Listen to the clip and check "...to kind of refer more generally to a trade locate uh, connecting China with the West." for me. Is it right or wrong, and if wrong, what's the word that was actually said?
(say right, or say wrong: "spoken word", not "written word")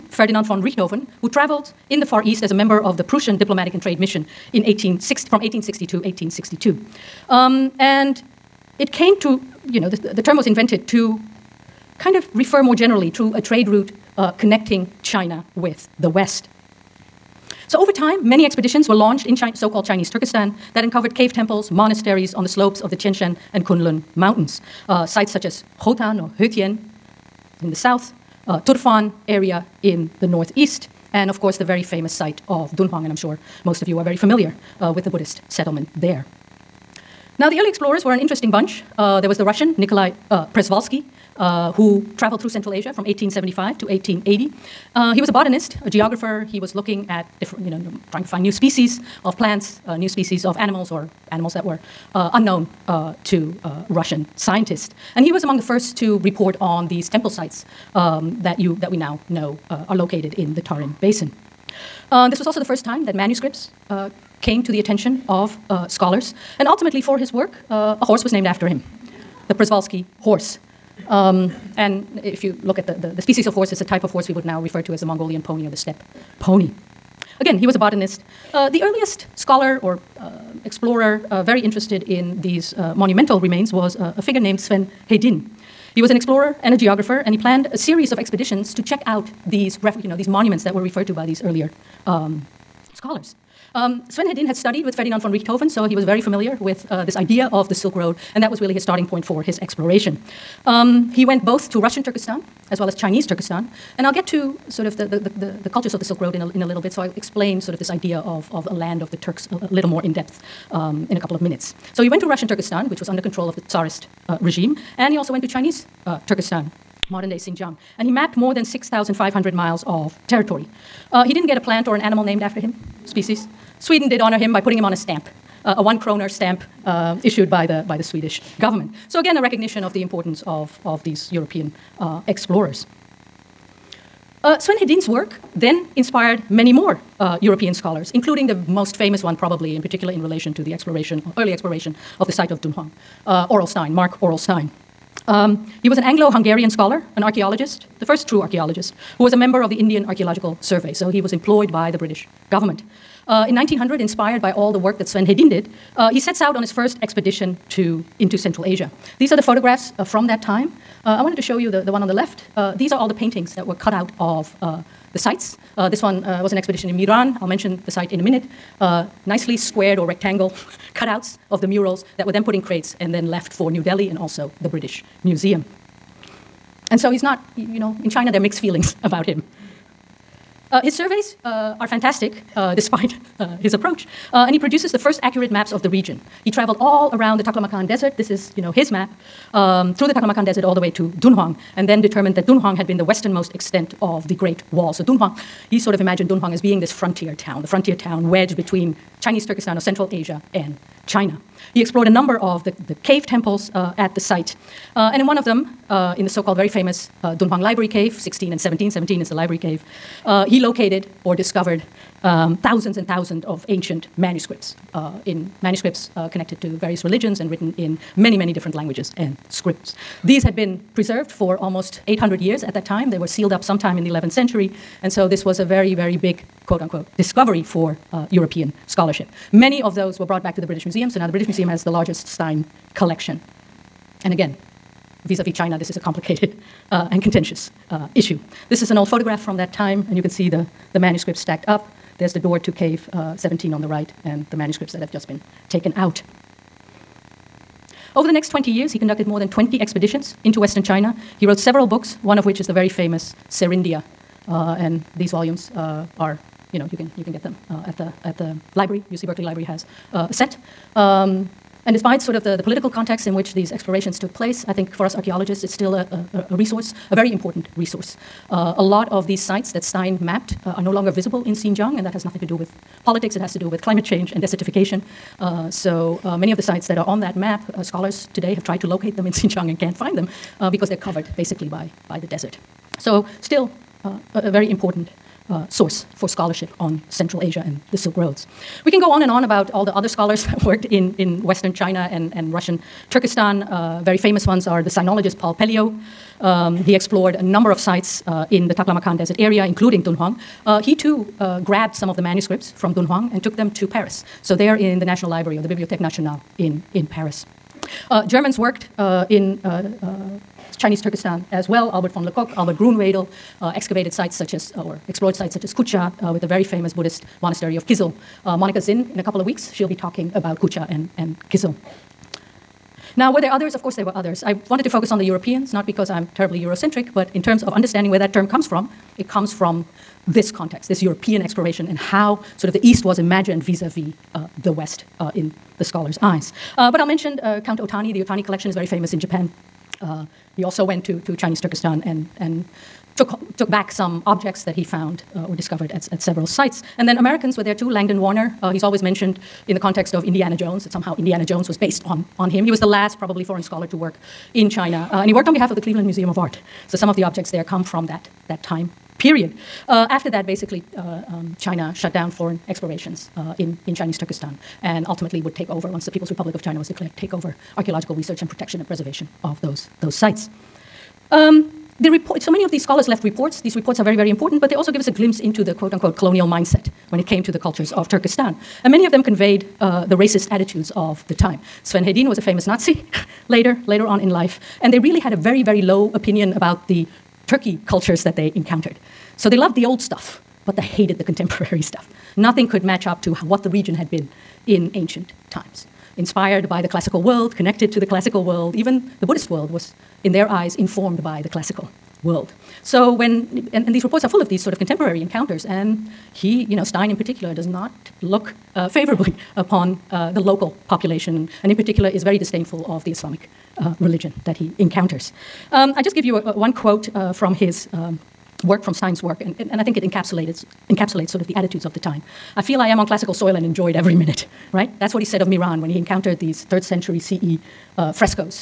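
wrong: "route", not "locate".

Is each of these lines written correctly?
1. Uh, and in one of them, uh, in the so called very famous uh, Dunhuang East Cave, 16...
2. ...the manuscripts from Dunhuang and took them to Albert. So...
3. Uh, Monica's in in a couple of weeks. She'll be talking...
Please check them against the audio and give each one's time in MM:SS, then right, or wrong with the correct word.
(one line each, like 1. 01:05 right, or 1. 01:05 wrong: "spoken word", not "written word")
1. 03:24 wrong: "Library", not "East"
2. 05:02 wrong: "Paris", not "Albert"
3. 05:18 right.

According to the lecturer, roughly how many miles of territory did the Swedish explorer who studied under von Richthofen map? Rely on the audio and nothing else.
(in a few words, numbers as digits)
6,500 miles.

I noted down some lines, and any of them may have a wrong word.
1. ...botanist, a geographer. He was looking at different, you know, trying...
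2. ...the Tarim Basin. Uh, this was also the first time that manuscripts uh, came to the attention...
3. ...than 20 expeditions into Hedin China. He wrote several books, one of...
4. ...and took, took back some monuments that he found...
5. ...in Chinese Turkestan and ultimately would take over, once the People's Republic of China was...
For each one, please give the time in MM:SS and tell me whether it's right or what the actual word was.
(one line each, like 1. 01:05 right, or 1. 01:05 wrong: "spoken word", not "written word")
1. 00:45 right
2. 01:00 right
3. 04:09 wrong: "Western", not "Hedin"
4. 05:42 wrong: "objects", not "monuments"
5. 06:03 right.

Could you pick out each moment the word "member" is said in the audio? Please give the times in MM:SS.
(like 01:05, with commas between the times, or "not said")
00:02, 02:29.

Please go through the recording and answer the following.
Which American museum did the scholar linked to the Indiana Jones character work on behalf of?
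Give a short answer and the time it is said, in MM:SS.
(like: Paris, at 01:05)
Cleveland Museum of Art, at 05:55.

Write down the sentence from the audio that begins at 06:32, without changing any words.
Nothing could match up to what the region had been in ancient times.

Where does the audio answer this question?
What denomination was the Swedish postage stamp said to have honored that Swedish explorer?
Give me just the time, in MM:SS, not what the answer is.
02:05.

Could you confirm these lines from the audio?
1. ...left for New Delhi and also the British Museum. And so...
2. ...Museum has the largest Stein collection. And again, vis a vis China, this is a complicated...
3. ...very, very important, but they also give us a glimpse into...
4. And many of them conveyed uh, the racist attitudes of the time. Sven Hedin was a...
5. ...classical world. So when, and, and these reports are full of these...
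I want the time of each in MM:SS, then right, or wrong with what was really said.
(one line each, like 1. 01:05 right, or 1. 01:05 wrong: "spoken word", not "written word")
1. 02:53 right
2. 03:51 right
3. 06:14 right
4. 06:18 right
5. 06:41 right.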